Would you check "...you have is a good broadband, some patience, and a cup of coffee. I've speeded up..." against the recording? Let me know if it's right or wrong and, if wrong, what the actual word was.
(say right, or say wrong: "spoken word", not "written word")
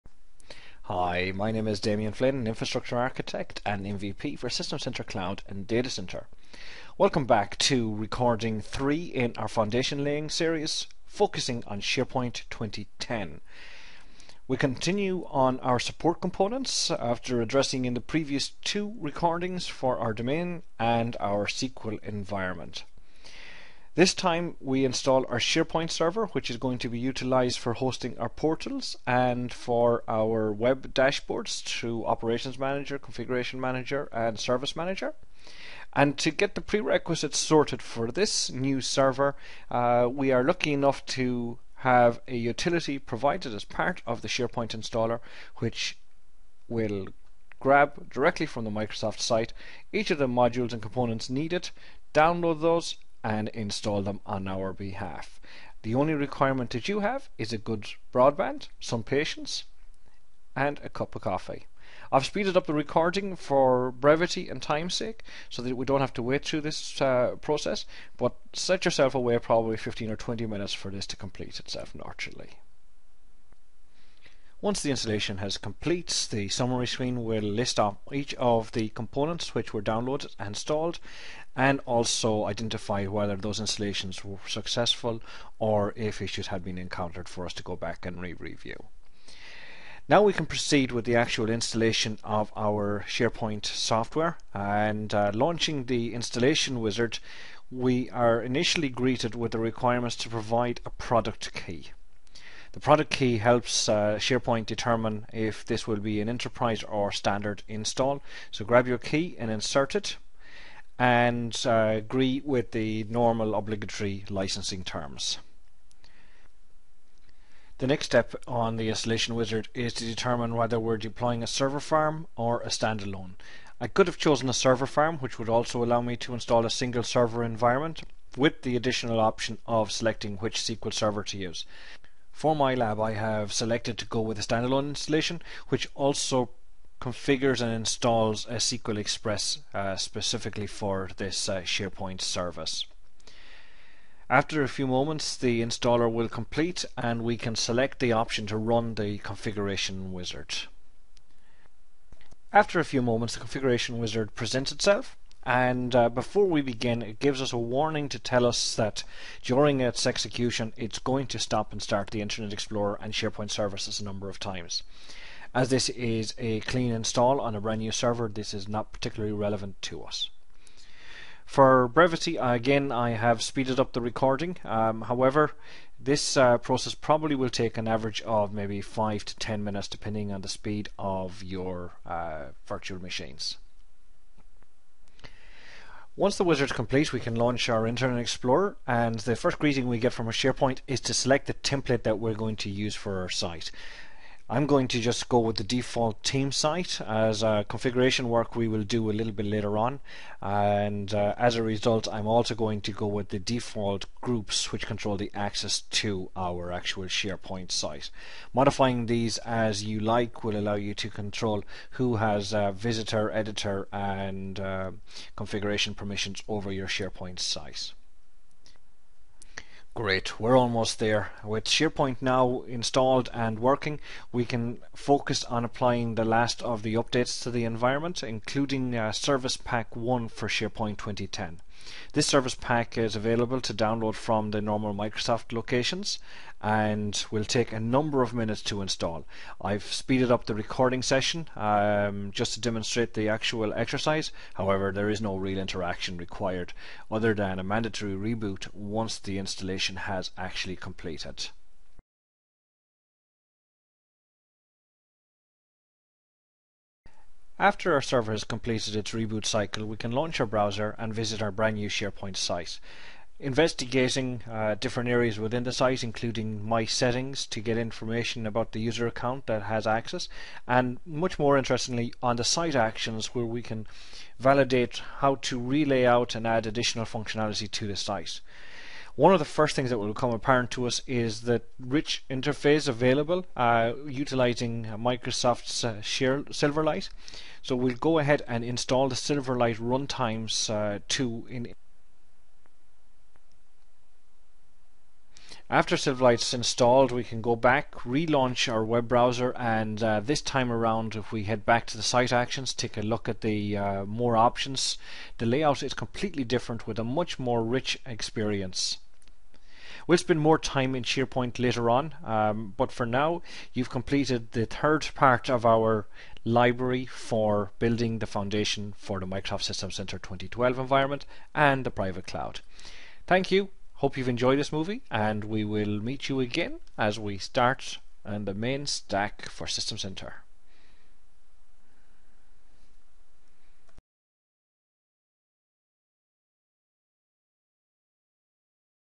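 right.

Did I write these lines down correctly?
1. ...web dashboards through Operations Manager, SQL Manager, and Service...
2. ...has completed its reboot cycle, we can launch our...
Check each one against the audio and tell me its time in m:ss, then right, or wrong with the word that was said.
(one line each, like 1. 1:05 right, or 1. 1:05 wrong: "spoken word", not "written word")
1. 0:30 wrong: "Configuration", not "SQL"
2. 4:18 right.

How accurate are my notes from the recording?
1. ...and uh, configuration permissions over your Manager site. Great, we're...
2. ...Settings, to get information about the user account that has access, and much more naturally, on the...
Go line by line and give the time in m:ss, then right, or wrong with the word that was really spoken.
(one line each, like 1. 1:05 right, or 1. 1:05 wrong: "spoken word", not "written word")
1. 3:33 wrong: "SharePoint", not "Manager"
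2. 4:26 wrong: "interestingly", not "naturally".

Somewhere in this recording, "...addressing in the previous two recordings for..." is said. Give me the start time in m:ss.
0:17.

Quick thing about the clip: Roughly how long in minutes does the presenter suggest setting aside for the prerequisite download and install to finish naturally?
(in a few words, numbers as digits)
15 or 20 minutes.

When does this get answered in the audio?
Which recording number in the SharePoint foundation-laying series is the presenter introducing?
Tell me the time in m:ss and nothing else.
0:07.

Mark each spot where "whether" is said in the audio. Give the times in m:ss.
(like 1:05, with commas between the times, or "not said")
1:23, 2:00.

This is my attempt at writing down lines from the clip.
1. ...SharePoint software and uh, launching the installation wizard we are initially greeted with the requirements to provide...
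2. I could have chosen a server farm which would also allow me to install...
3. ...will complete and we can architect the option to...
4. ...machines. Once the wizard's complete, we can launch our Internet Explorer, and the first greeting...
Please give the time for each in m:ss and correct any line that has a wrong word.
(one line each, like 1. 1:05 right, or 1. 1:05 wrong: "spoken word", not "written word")
1. 1:33 right
2. 2:03 right
3. 2:26 wrong: "select", not "architect"
4. 3:03 right.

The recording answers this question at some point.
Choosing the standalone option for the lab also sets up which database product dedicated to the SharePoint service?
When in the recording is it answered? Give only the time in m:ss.
2:18.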